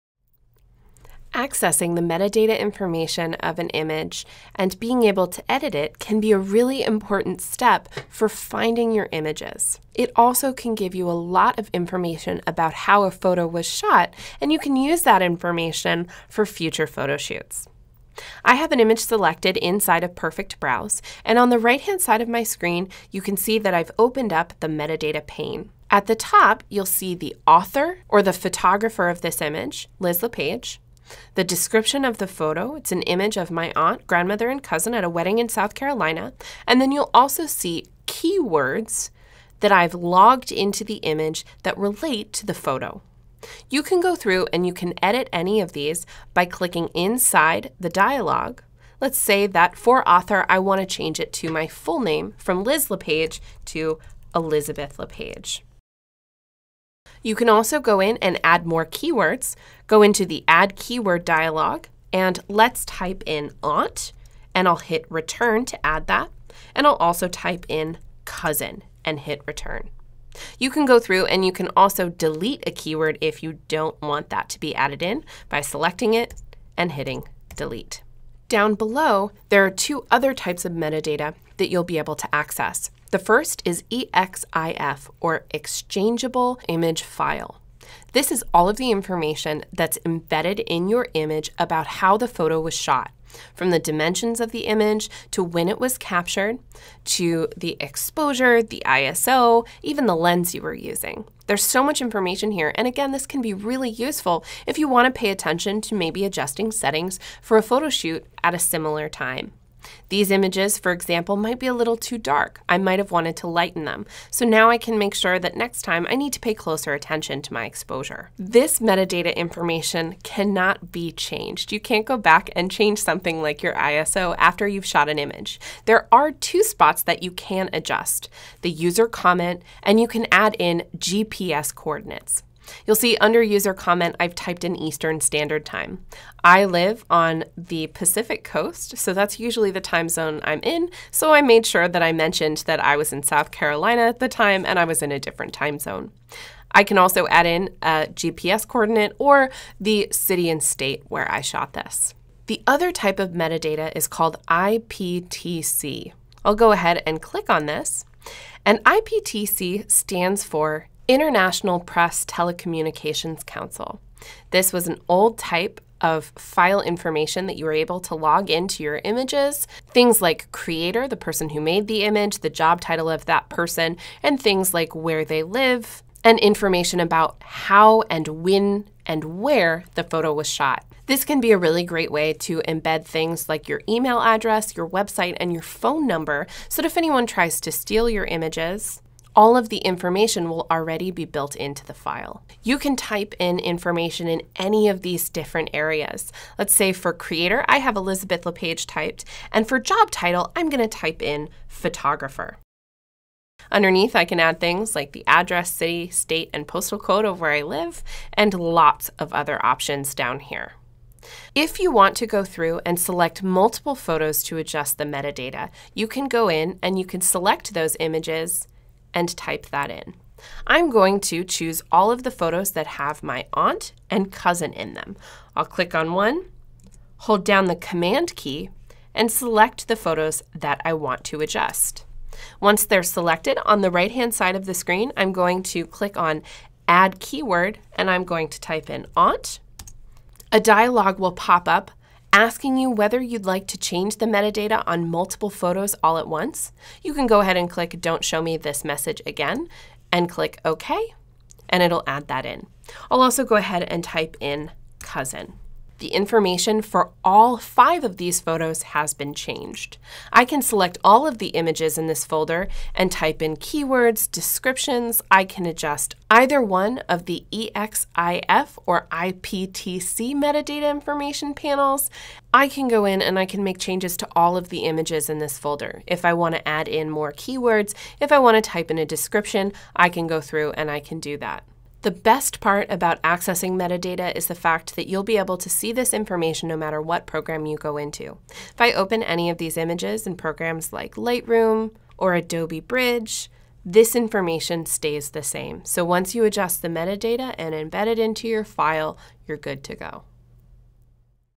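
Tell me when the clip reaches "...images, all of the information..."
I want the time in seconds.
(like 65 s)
188 s.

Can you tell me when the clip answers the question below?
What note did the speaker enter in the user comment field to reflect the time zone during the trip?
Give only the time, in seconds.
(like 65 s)
134 s.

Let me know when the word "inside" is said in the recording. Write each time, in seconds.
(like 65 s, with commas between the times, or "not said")
19 s, 46 s.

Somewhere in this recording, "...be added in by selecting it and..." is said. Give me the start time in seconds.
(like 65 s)
74 s.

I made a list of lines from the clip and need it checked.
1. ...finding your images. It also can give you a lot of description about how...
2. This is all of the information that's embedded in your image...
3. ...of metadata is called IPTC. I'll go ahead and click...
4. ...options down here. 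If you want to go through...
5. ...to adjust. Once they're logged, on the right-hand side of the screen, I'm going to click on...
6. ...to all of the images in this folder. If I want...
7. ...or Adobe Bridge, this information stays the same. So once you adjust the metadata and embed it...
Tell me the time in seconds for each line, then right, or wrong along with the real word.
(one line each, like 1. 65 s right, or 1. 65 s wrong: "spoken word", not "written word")
1. 8 s wrong: "information", not "description"
2. 88 s right
3. 153 s right
4. 209 s right
5. 231 s wrong: "selected", not "logged"
6. 274 s right
7. 292 s right.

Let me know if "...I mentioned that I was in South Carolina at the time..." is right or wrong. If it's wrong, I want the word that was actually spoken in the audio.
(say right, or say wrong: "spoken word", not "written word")
right.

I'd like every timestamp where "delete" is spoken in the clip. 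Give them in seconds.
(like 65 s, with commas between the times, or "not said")
72 s, 77 s.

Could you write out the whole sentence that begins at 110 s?
These images, for example, might be a little too dark.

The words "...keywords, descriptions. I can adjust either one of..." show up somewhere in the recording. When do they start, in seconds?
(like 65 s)
263 s.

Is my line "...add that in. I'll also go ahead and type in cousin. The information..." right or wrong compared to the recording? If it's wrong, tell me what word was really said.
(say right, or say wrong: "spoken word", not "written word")
right.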